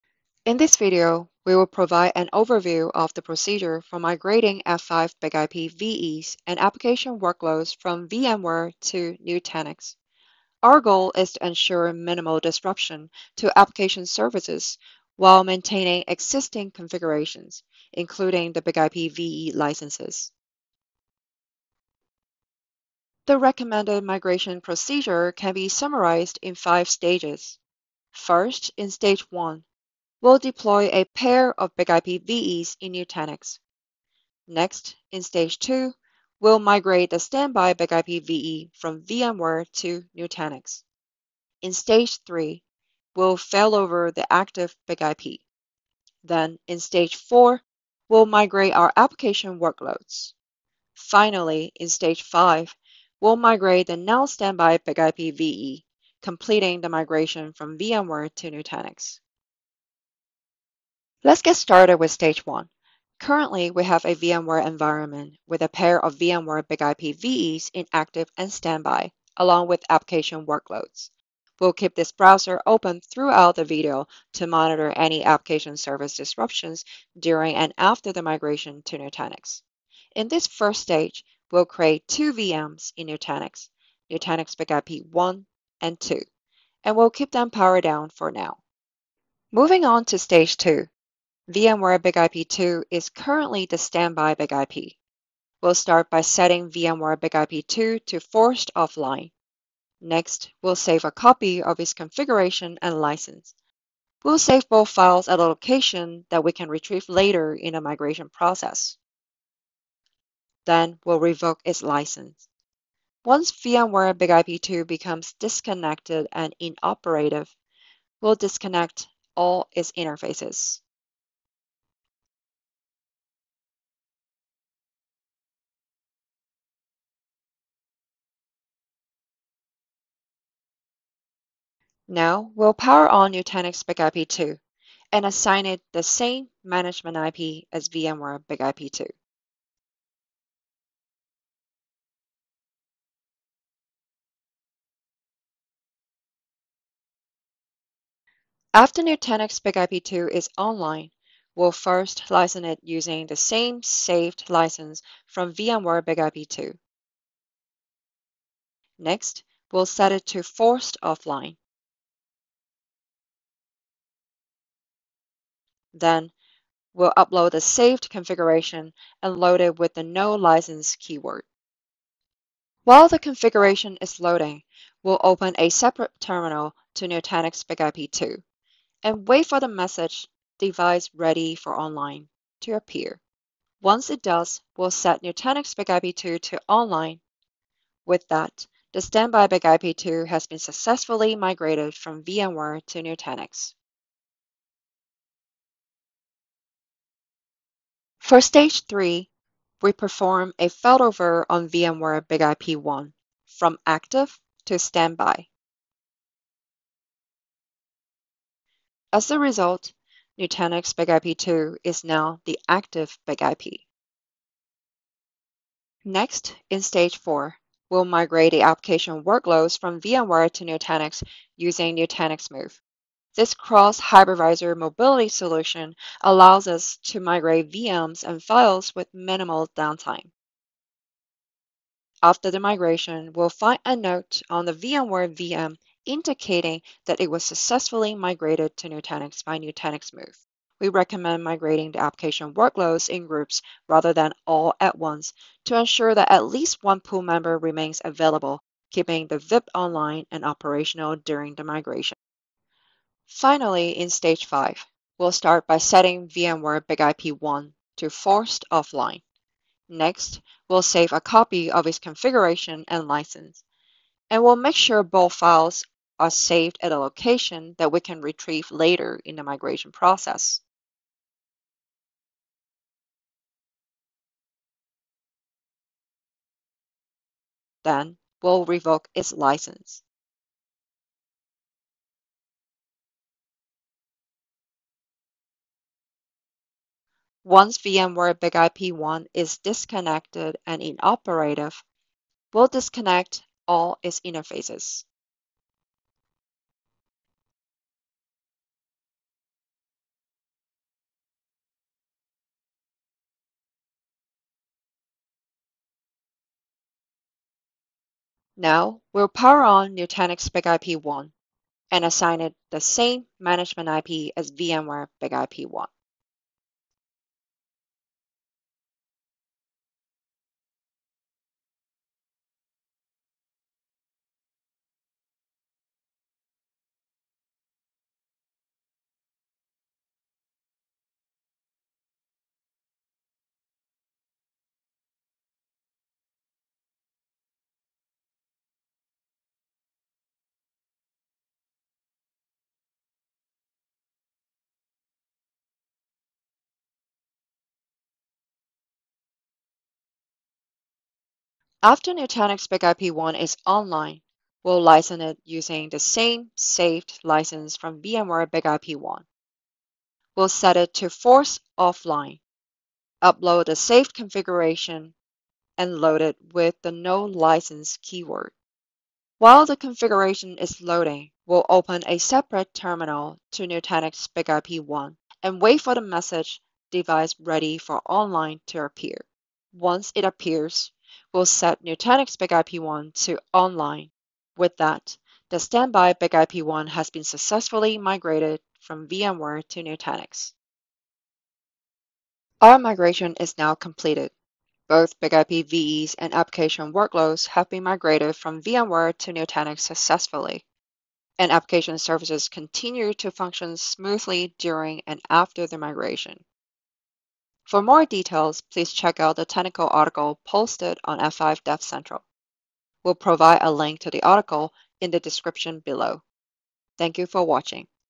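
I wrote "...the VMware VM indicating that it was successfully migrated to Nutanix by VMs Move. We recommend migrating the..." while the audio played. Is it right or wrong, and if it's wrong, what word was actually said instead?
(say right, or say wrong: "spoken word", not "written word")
wrong: "Nutanix", not "VMs".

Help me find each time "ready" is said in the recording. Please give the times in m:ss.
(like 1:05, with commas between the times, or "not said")
3:01, 6:17.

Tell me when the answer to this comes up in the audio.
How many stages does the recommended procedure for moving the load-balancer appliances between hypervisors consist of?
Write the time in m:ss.
0:26.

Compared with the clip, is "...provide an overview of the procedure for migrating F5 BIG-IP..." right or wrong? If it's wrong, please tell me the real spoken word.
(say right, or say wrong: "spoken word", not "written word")
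right.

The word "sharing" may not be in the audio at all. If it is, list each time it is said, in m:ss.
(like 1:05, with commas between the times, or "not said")
not said.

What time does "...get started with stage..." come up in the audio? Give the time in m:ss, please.
1:01.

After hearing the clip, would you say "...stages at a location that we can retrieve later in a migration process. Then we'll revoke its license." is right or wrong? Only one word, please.
wrong.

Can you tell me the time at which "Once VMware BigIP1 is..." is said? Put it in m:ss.
4:47.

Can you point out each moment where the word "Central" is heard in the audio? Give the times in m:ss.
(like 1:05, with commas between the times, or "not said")
6:51.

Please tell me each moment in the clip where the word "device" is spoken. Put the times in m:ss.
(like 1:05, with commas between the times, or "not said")
3:00, 6:16.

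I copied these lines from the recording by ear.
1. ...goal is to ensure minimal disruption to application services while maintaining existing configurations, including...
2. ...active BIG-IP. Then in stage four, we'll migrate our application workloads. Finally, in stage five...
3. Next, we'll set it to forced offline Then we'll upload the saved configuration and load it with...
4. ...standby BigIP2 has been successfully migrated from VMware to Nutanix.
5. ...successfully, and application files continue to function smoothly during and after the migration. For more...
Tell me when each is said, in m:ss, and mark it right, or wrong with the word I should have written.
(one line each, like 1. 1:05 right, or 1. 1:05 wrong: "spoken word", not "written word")
1. 0:10 right
2. 0:44 right
3. 2:38 right
4. 3:09 right
5. 6:39 wrong: "services", not "files".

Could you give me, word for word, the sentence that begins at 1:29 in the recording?
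Moving on to stage 2, VMware BigIP2 is currently the standby BigIP.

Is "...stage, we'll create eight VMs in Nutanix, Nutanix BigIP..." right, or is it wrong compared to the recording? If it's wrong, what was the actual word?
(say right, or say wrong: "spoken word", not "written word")
wrong: "two", not "eight".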